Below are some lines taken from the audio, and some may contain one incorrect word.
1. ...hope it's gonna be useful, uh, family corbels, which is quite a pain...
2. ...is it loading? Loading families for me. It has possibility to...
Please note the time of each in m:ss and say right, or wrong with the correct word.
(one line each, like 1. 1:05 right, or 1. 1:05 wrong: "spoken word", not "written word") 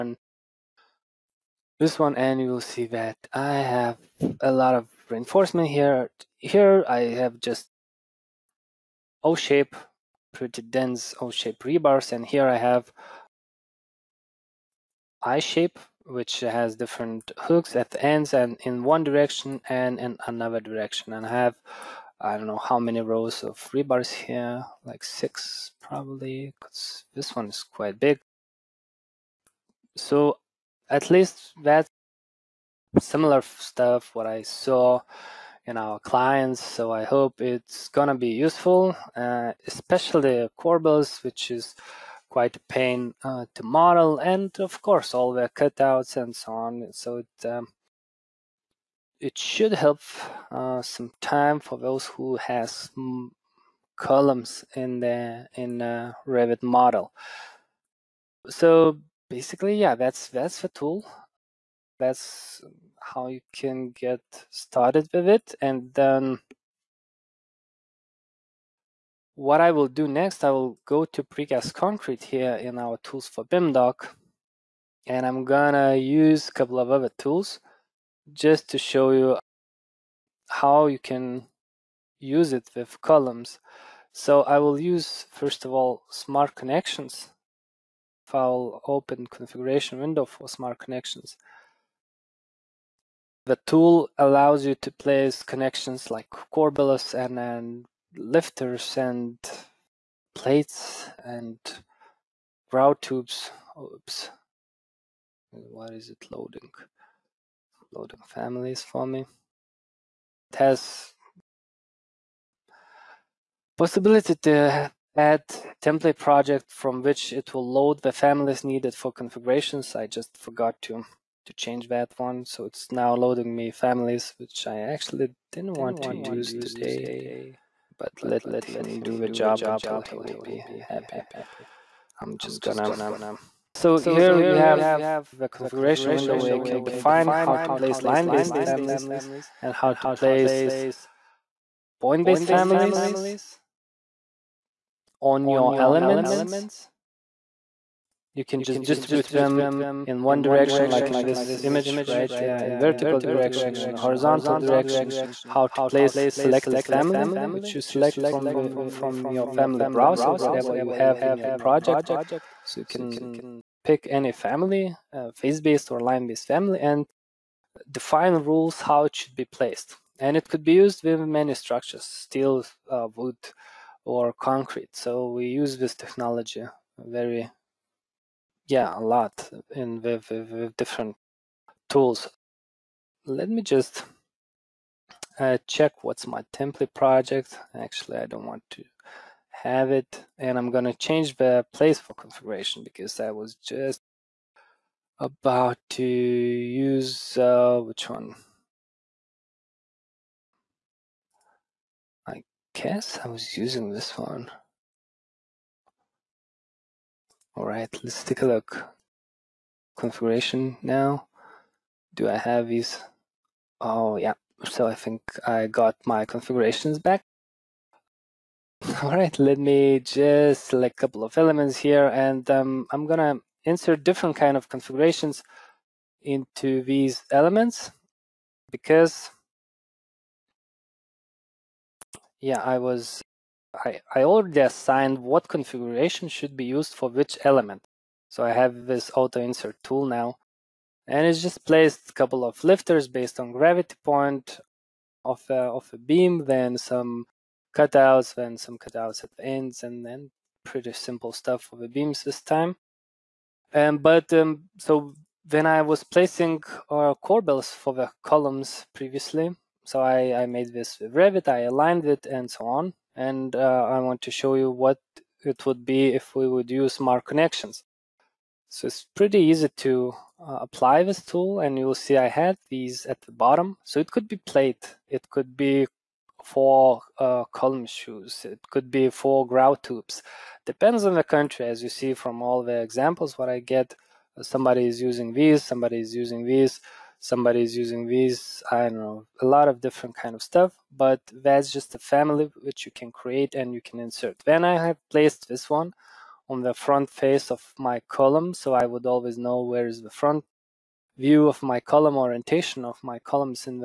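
1. 0:37 wrong: "especially", not "family"
2. 1:45 right.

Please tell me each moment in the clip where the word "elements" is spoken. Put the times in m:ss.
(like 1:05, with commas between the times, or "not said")
2:25, 3:41, 3:47, 3:57.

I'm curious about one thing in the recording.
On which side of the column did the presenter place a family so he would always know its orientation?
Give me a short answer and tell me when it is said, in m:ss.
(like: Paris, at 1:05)
front face, at 4:56.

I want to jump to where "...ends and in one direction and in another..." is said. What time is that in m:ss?
0:18.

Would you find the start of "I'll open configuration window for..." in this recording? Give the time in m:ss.
1:28.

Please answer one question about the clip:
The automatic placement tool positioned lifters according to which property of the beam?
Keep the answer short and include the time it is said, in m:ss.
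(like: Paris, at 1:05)
gravity point, at 4:03.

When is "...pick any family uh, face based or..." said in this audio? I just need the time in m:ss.
2:43.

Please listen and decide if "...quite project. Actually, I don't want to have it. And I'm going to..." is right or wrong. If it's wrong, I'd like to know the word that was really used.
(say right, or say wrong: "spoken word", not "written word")
wrong: "template", not "quite".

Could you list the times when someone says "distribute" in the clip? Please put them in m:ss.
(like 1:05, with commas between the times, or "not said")
2:28.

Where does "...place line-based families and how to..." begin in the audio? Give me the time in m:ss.
2:17.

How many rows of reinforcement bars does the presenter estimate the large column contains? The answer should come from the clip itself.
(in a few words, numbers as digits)
6.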